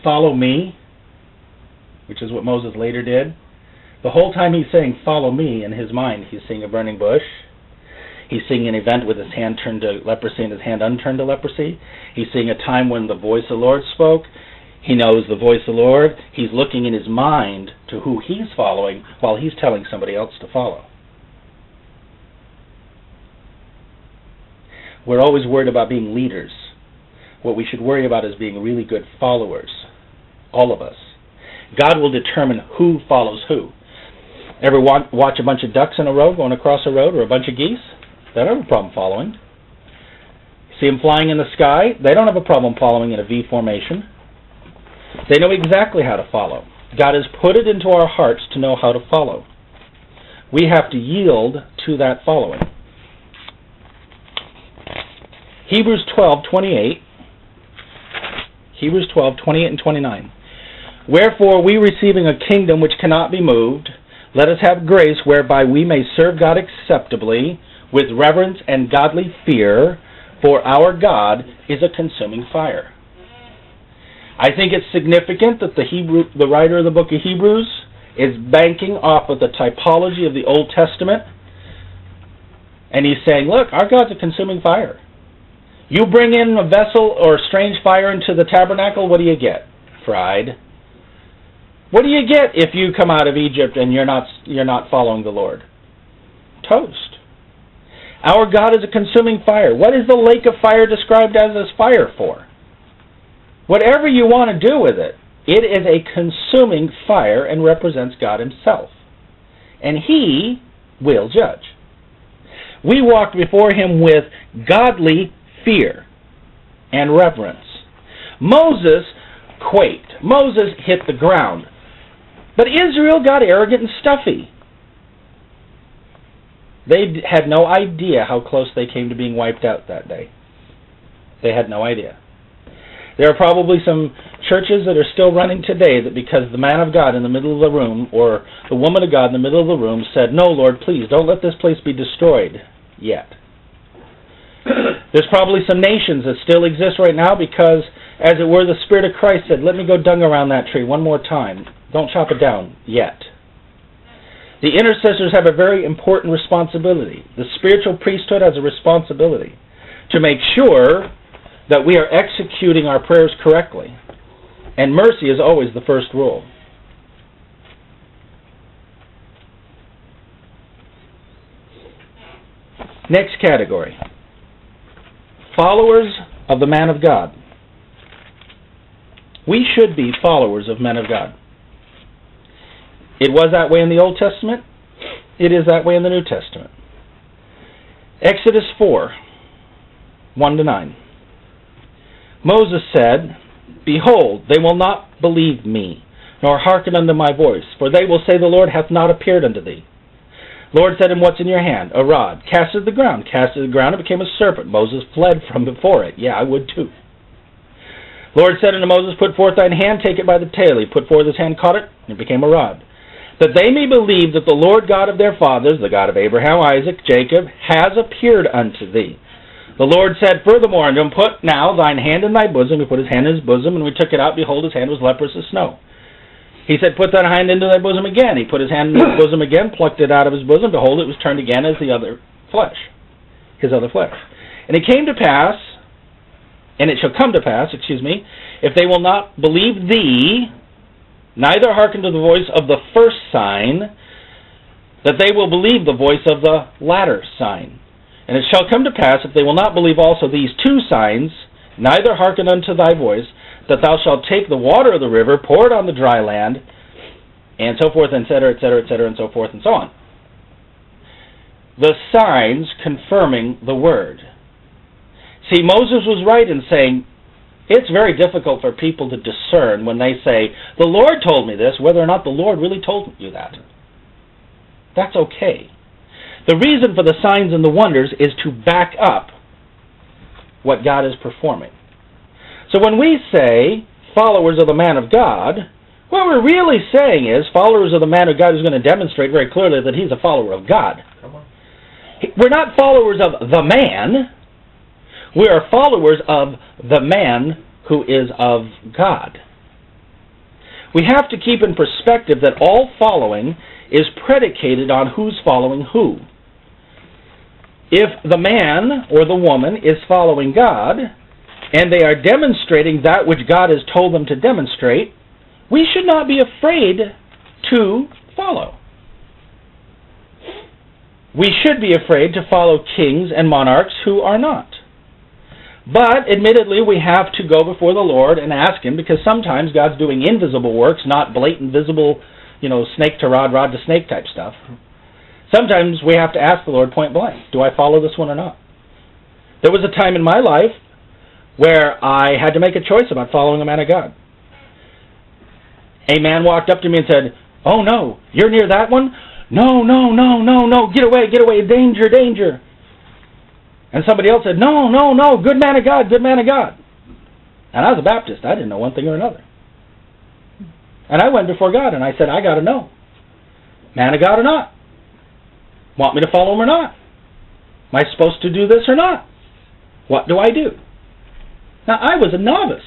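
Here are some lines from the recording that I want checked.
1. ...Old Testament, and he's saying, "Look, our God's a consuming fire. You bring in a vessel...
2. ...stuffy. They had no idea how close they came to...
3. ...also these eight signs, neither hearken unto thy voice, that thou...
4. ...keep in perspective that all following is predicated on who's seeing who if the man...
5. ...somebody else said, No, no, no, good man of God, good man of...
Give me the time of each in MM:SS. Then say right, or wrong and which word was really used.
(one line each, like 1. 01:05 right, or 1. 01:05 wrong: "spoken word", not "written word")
1. 01:20 right
2. 02:03 right
3. 04:09 wrong: "two", not "eight"
4. 05:01 wrong: "following", not "seeing"
5. 05:54 right.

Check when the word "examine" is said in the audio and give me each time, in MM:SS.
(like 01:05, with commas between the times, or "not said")
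not said.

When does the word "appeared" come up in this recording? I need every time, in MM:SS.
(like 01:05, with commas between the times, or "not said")
03:19, 03:37.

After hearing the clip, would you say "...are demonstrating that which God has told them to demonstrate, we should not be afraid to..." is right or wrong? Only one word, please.
right.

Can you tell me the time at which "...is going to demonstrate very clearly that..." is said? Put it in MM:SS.
04:48.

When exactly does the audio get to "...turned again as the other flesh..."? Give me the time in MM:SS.
03:51.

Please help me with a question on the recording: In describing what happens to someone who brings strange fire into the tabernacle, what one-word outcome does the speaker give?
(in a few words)
Fried.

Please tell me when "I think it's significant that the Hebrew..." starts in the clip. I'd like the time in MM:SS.
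01:14.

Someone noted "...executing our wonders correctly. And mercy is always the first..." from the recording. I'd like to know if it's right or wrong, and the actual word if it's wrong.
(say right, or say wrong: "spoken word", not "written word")
wrong: "prayers", not "wonders".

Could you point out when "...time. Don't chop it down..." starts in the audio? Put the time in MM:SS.
02:31.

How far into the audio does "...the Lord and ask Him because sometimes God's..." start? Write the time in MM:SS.
05:27.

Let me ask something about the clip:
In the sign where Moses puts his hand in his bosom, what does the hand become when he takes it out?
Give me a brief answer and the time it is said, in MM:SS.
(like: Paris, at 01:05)
Leprous as snow, at 03:45.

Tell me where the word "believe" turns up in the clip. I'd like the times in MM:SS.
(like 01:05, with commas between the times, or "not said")
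03:15, 03:33, 03:59, 04:05, 04:09.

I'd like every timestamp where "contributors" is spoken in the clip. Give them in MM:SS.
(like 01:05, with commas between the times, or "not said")
not said.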